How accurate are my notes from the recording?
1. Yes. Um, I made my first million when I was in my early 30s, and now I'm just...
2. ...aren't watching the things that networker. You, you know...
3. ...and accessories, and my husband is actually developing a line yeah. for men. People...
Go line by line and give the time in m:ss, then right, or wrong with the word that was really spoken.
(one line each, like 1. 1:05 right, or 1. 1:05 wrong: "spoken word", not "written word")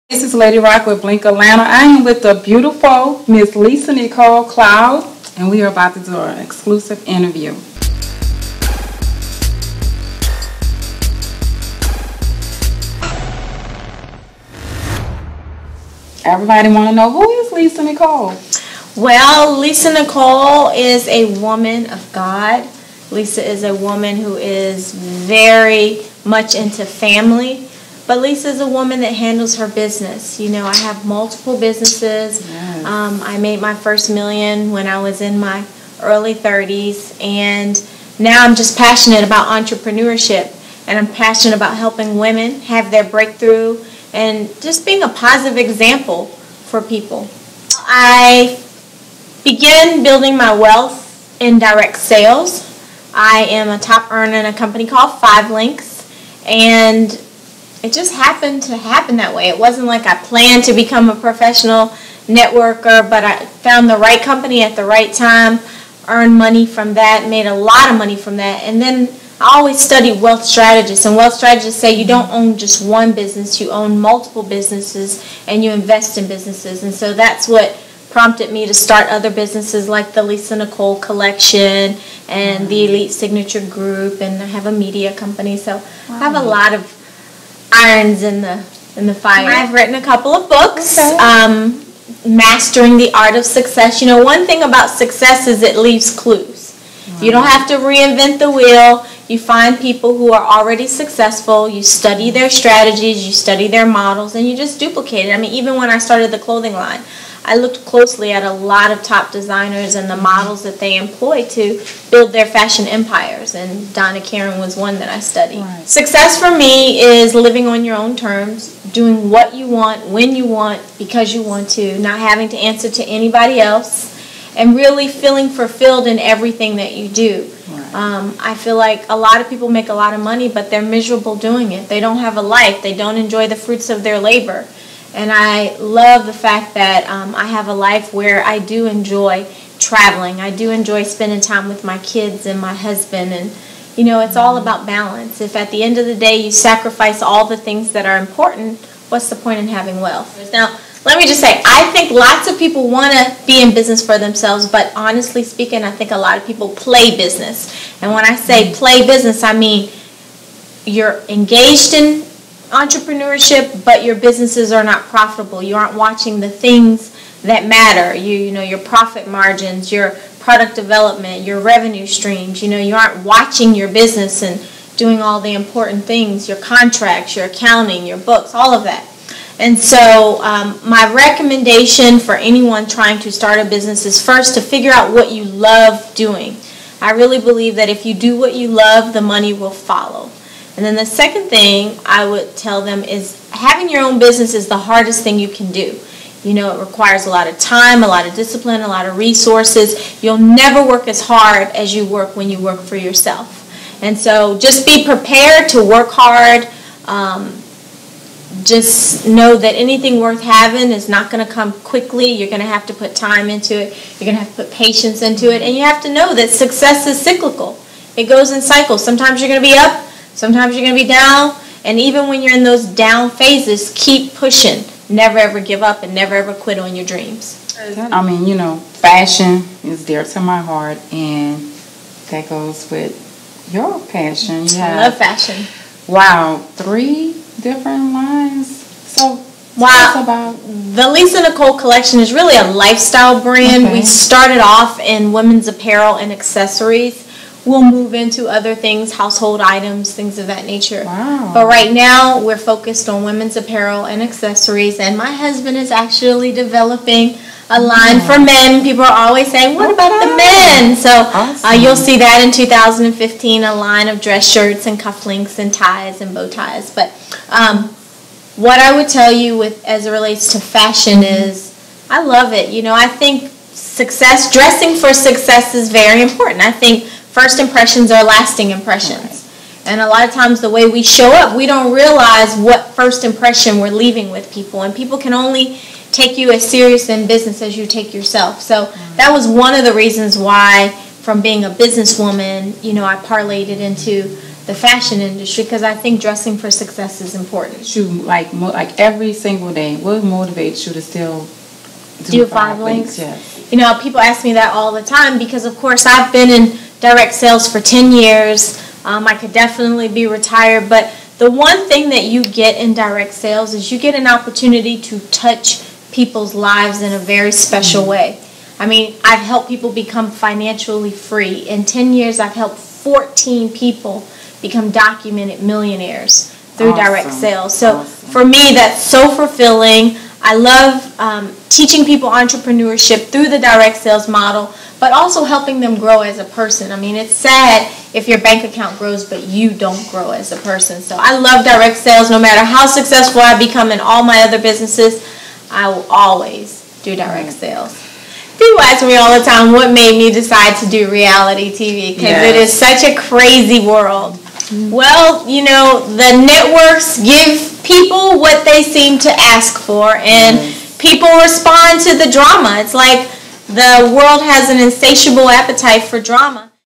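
1. 0:32 right
2. 2:45 wrong: "matter", not "networker"
3. 4:14 right.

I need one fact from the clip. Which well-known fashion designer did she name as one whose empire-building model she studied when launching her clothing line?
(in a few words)
Donna Karan.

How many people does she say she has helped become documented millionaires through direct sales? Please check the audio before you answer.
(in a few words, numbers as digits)
14.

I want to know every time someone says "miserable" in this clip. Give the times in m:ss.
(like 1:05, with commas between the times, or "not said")
2:10.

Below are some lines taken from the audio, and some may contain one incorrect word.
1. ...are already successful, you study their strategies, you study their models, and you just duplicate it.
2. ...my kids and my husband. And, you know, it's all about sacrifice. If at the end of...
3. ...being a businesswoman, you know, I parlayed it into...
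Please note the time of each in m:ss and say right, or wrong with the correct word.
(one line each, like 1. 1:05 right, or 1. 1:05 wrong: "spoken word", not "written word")
1. 1:40 right
2. 2:21 wrong: "balance", not "sacrifice"
3. 4:51 right.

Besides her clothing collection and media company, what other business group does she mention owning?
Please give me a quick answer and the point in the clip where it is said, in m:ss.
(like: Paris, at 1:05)
Elite Signature Group, at 1:22.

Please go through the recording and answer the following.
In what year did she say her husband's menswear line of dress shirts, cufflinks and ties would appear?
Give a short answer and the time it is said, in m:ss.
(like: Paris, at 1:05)
2015, at 4:22.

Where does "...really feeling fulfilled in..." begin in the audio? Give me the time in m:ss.
2:04.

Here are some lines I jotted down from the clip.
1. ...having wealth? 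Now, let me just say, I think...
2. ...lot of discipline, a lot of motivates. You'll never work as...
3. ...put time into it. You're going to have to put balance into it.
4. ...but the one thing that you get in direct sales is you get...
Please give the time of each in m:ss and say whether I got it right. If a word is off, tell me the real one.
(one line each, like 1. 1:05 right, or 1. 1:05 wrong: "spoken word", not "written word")
1. 2:29 right
2. 3:18 wrong: "resources", not "motivates"
3. 3:32 wrong: "patience", not "balance"
4. 5:10 right.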